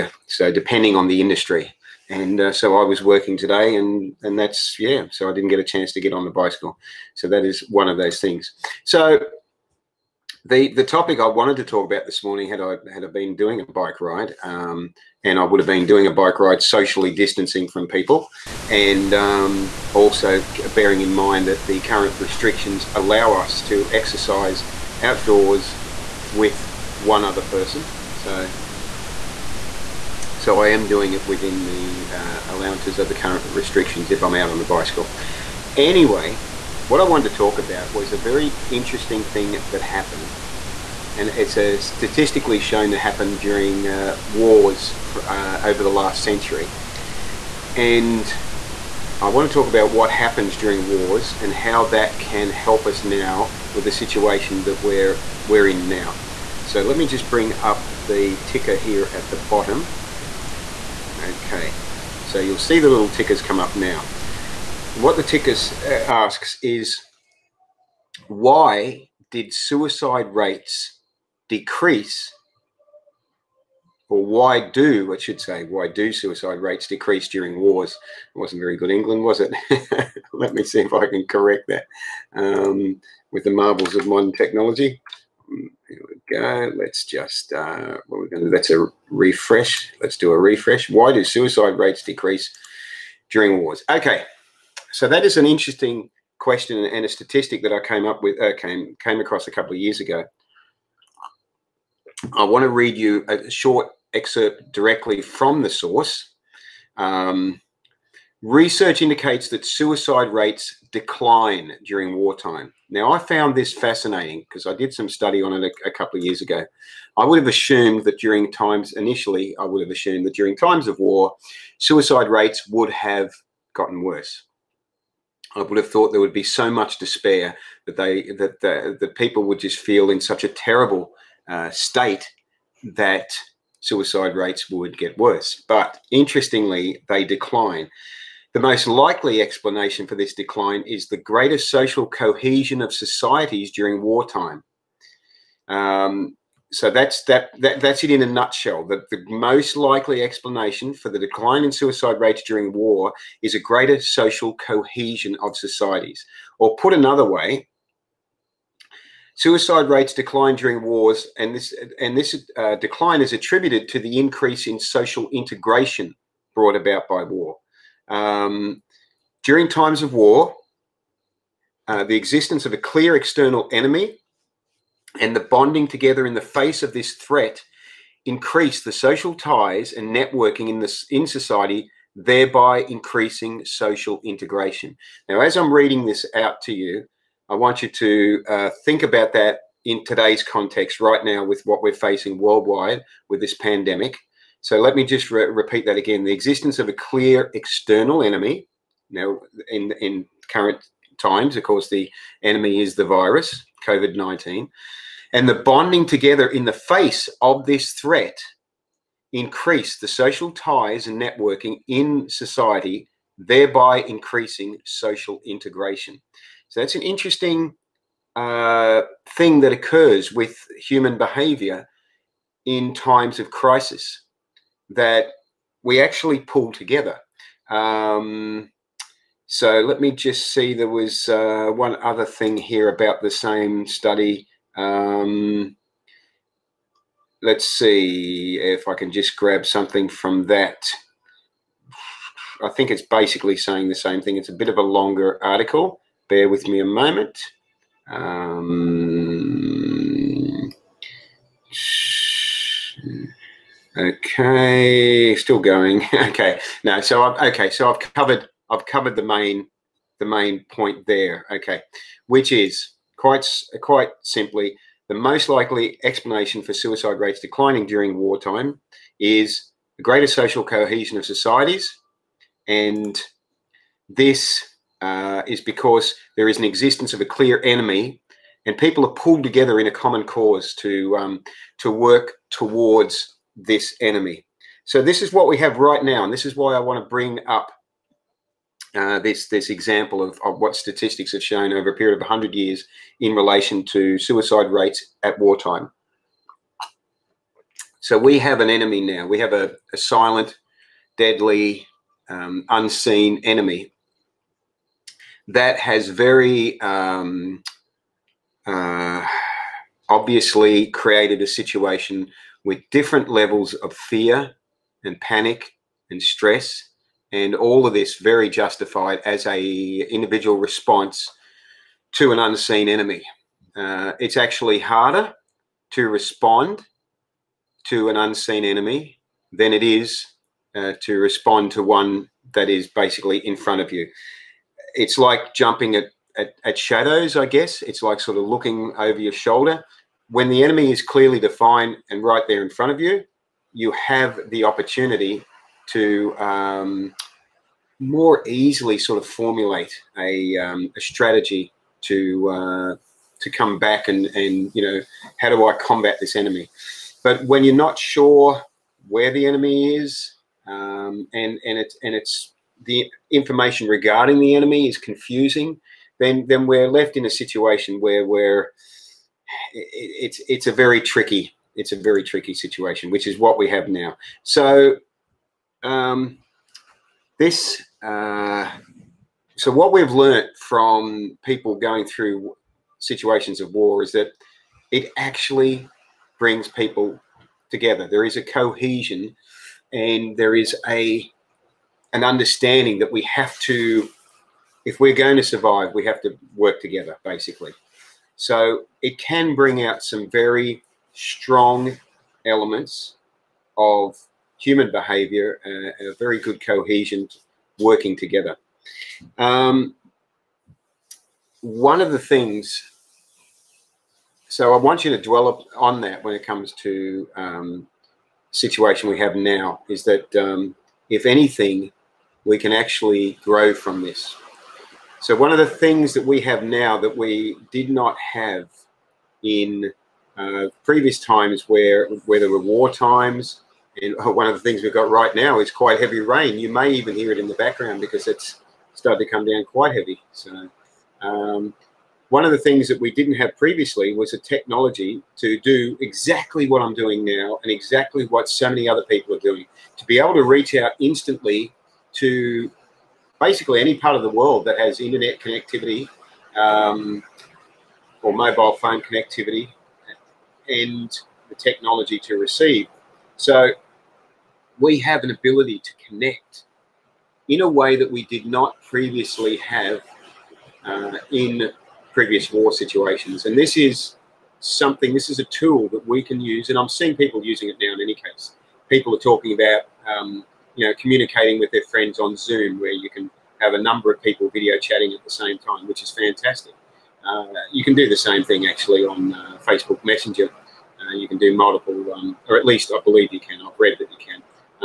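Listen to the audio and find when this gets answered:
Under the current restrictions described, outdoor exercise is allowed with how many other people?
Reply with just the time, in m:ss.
0:26.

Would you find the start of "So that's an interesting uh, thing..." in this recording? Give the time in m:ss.
3:36.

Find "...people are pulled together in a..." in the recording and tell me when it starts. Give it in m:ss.
4:38.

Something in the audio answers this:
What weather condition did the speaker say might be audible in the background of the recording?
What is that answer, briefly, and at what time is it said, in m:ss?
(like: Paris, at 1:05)
Heavy rain, at 7:15.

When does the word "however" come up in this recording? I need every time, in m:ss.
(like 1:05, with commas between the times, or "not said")
not said.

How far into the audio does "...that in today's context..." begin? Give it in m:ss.
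3:09.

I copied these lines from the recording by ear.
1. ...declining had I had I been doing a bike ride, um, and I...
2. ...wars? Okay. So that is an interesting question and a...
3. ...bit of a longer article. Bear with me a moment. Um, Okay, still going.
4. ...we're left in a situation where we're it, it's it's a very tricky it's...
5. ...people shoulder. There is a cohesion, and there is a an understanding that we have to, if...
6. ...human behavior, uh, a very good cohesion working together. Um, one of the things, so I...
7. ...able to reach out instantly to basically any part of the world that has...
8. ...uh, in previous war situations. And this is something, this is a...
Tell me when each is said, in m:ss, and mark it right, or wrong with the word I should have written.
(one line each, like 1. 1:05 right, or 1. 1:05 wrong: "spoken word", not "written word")
1. 0:12 wrong: "morning", not "declining"
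2. 1:33 right
3. 4:04 right
4. 6:06 right
5. 6:26 wrong: "together", not "shoulder"
6. 6:44 right
7. 7:30 right
8. 7:50 right.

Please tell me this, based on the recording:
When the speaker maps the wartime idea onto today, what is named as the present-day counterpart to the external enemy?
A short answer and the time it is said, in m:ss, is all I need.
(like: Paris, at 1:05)
COVID 19, at 3:23.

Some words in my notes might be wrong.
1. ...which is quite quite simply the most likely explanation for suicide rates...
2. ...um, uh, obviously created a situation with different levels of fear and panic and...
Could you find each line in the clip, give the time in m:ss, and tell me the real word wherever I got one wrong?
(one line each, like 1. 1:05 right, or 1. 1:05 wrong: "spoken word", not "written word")
1. 4:22 right
2. 5:06 right.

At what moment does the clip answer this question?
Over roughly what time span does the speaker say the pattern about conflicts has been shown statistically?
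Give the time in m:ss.
0:45.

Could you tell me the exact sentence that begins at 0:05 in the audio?
So I didn't get a chance to get on the bicycle.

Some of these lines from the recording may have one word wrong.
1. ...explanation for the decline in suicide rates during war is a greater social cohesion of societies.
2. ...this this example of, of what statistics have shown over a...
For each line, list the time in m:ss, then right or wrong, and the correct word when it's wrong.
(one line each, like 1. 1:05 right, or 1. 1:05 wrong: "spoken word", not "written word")
1. 2:30 right
2. 4:49 right.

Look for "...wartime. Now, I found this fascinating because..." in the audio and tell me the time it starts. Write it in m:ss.
1:52.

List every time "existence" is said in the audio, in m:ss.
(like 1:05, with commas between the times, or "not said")
2:52, 3:16, 4:36.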